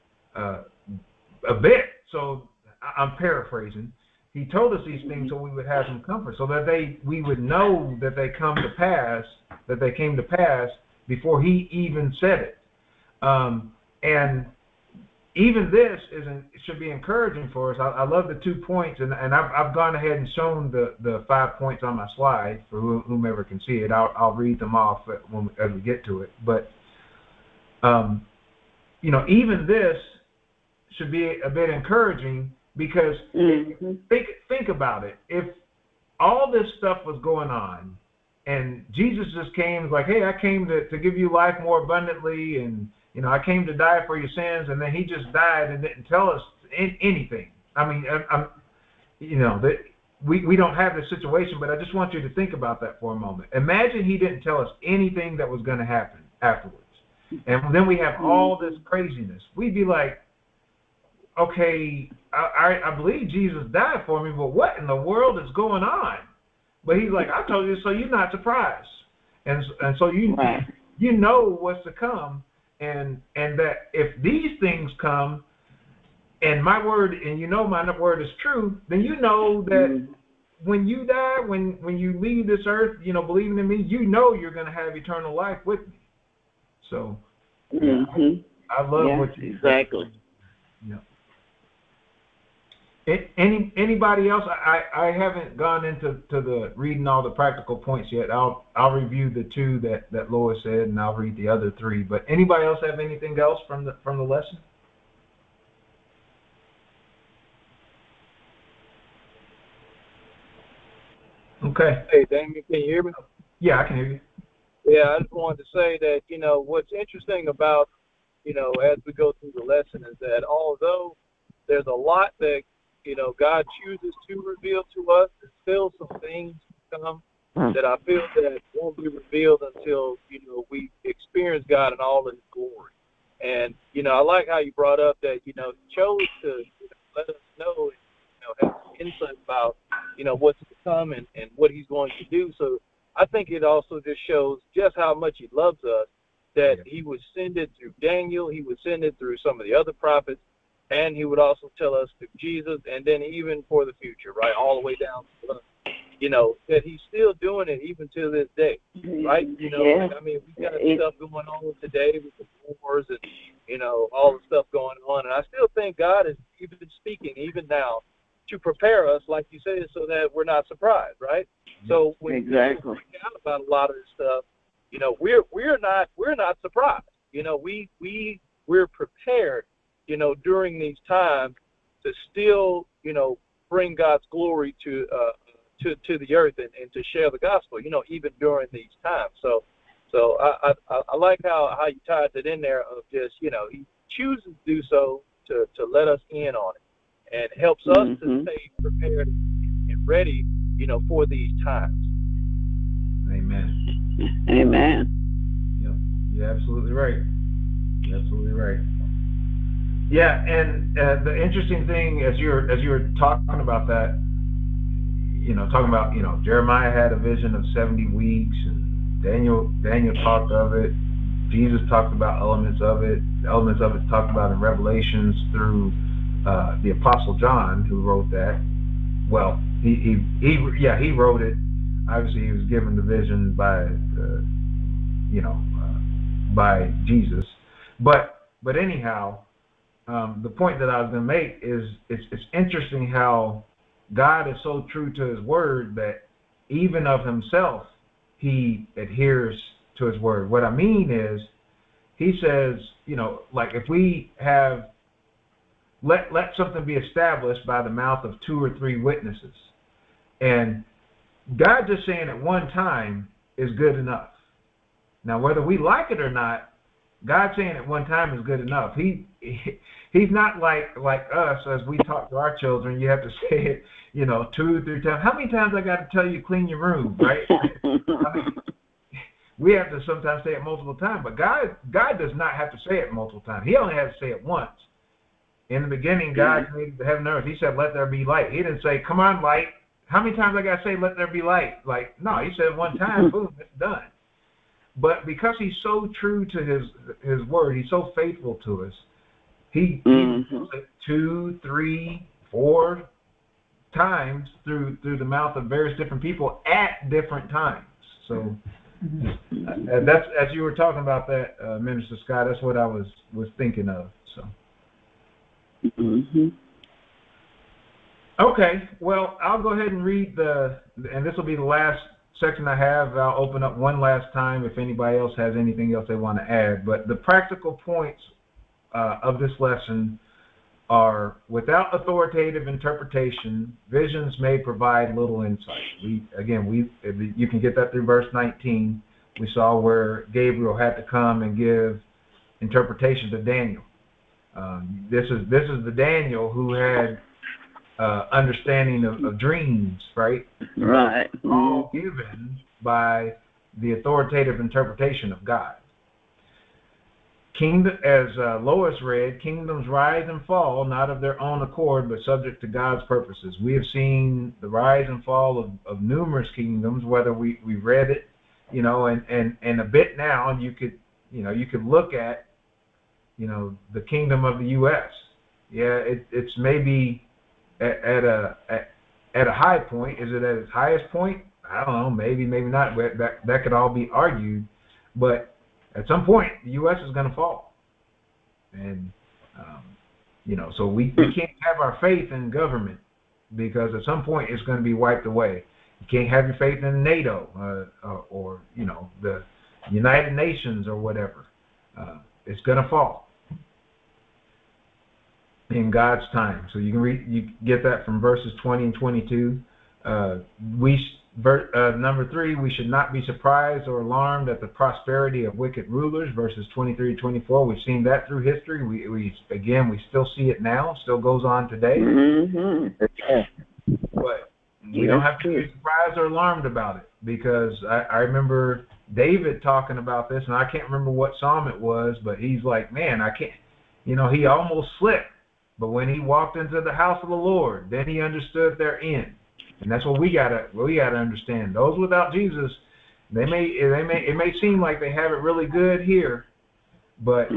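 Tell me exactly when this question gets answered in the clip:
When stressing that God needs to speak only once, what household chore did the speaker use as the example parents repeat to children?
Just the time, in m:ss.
4:36.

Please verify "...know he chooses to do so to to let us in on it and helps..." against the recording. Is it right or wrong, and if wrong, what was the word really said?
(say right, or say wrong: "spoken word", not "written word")
right.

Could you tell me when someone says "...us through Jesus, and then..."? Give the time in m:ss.
2:31.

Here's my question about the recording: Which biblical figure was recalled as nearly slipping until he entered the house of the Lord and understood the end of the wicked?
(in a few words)
David.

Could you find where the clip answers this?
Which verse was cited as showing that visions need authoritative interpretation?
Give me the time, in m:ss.
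5:38.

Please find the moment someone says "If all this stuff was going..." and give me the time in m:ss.
0:35.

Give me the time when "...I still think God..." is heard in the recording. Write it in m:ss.
2:45.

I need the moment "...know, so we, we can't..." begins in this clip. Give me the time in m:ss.
6:30.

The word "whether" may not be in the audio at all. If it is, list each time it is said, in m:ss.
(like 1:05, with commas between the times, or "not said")
4:25, 6:07.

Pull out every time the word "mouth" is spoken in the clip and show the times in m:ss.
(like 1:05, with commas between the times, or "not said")
4:17, 5:05.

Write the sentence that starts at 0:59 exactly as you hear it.
We'd be like, okay, I, I, I believe Jesus died for me, but what in the world is going on?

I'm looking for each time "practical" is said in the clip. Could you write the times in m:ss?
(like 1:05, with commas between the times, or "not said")
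1:37, 5:27.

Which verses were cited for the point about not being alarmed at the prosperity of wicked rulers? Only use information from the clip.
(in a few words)
23 to 24.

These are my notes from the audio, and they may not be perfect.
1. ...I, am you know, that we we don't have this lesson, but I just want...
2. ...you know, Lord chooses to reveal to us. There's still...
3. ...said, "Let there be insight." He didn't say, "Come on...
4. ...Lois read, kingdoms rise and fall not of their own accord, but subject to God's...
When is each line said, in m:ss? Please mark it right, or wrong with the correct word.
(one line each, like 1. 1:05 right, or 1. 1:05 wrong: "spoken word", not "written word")
1. 0:48 wrong: "situation", not "lesson"
2. 2:03 wrong: "God", not "Lord"
3. 4:47 wrong: "light", not "insight"
4. 5:58 right.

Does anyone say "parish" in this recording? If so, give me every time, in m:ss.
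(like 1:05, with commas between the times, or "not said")
not said.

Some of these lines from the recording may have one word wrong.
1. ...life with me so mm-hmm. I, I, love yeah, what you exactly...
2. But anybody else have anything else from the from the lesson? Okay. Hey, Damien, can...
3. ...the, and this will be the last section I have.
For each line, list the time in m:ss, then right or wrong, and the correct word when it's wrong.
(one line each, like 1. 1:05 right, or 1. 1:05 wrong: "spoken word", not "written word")
1. 1:25 right
2. 1:42 right
3. 5:20 right.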